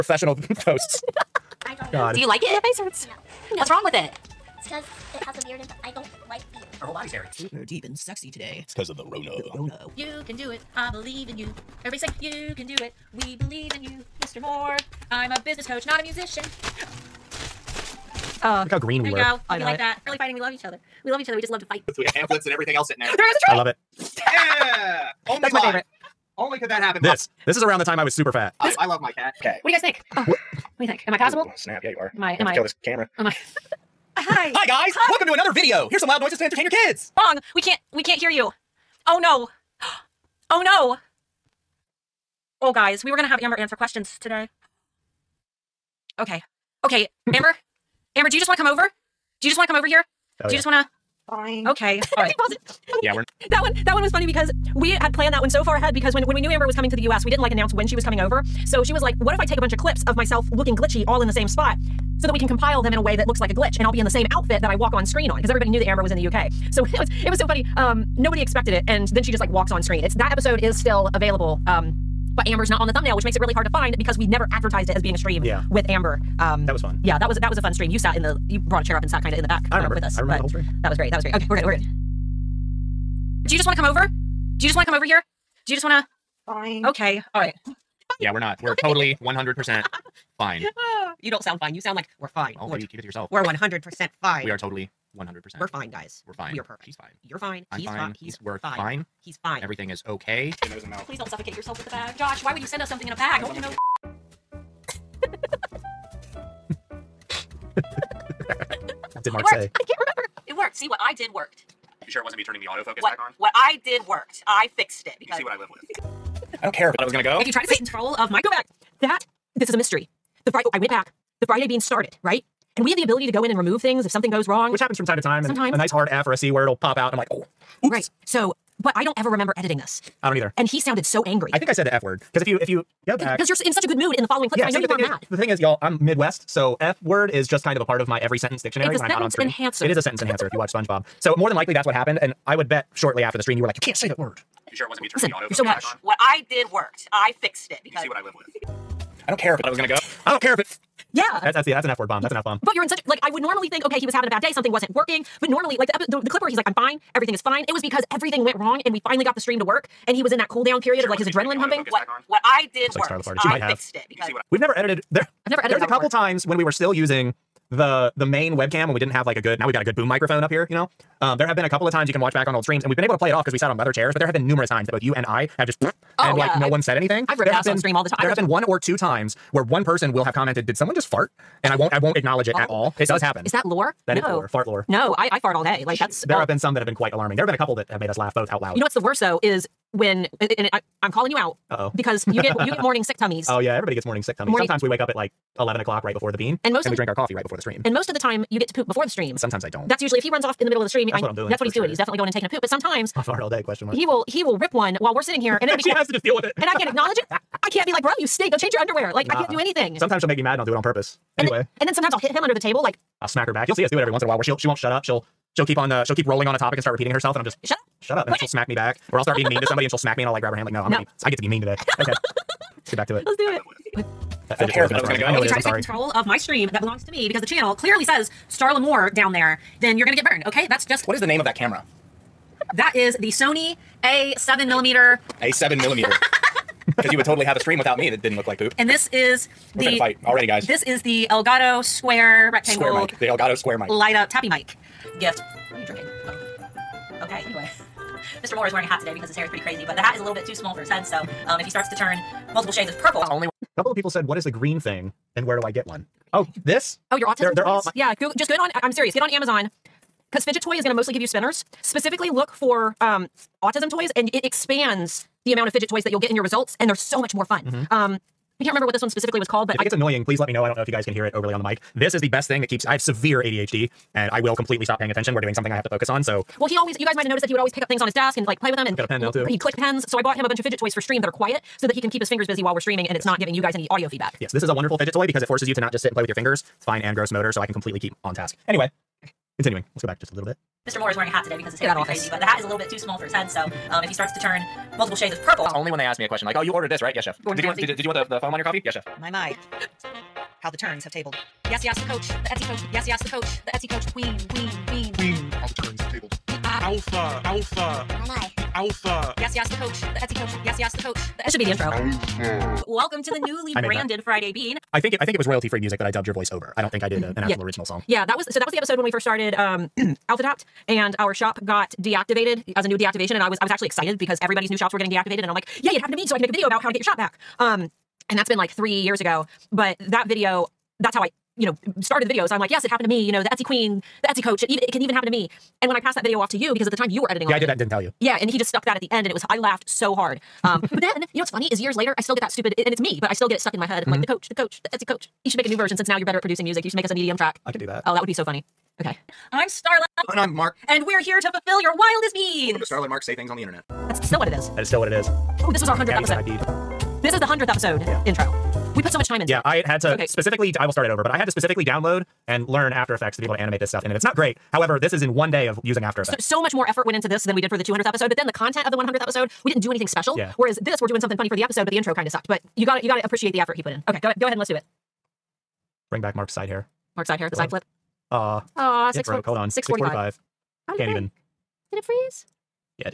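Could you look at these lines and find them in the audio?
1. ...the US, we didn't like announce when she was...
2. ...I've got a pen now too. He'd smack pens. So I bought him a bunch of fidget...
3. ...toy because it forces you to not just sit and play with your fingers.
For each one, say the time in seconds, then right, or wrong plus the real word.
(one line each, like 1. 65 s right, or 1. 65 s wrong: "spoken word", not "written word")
1. 56 s right
2. 278 s wrong: "click", not "smack"
3. 285 s right.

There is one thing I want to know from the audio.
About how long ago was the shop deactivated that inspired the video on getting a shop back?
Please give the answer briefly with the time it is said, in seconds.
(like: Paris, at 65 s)
3 years, at 328 s.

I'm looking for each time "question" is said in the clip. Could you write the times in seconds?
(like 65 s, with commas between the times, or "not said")
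43 s, 203 s, 296 s.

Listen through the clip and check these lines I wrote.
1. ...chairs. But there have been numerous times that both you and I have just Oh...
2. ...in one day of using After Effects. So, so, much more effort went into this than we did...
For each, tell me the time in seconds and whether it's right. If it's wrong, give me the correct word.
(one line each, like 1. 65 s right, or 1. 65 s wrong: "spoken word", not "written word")
1. 173 s right
2. 365 s right.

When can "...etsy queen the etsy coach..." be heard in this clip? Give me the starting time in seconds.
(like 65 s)
333 s.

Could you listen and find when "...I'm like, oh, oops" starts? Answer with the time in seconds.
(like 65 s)
127 s.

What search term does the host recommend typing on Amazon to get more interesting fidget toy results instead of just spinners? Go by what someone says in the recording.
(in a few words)
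autism toys.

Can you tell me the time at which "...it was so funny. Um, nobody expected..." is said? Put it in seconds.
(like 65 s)
67 s.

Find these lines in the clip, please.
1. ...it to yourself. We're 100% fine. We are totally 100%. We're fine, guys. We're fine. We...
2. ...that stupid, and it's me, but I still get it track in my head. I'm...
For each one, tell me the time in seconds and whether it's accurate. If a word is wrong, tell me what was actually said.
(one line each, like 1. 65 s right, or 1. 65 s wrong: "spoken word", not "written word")
1. 92 s right
2. 342 s wrong: "stuck", not "track".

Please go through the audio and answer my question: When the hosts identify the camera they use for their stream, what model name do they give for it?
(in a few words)
Sony A7.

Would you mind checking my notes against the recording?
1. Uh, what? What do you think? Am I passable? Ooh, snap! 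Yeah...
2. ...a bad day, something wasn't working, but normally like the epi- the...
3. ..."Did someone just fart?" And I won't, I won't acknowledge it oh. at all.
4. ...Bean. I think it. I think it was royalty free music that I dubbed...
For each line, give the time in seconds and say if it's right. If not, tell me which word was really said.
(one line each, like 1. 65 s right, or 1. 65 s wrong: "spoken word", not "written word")
1. 30 s right
2. 154 s right
3. 180 s right
4. 314 s right.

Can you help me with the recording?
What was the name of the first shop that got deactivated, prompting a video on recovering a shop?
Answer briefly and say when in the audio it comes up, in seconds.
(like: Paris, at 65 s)
Alpha Adopt, at 320 s.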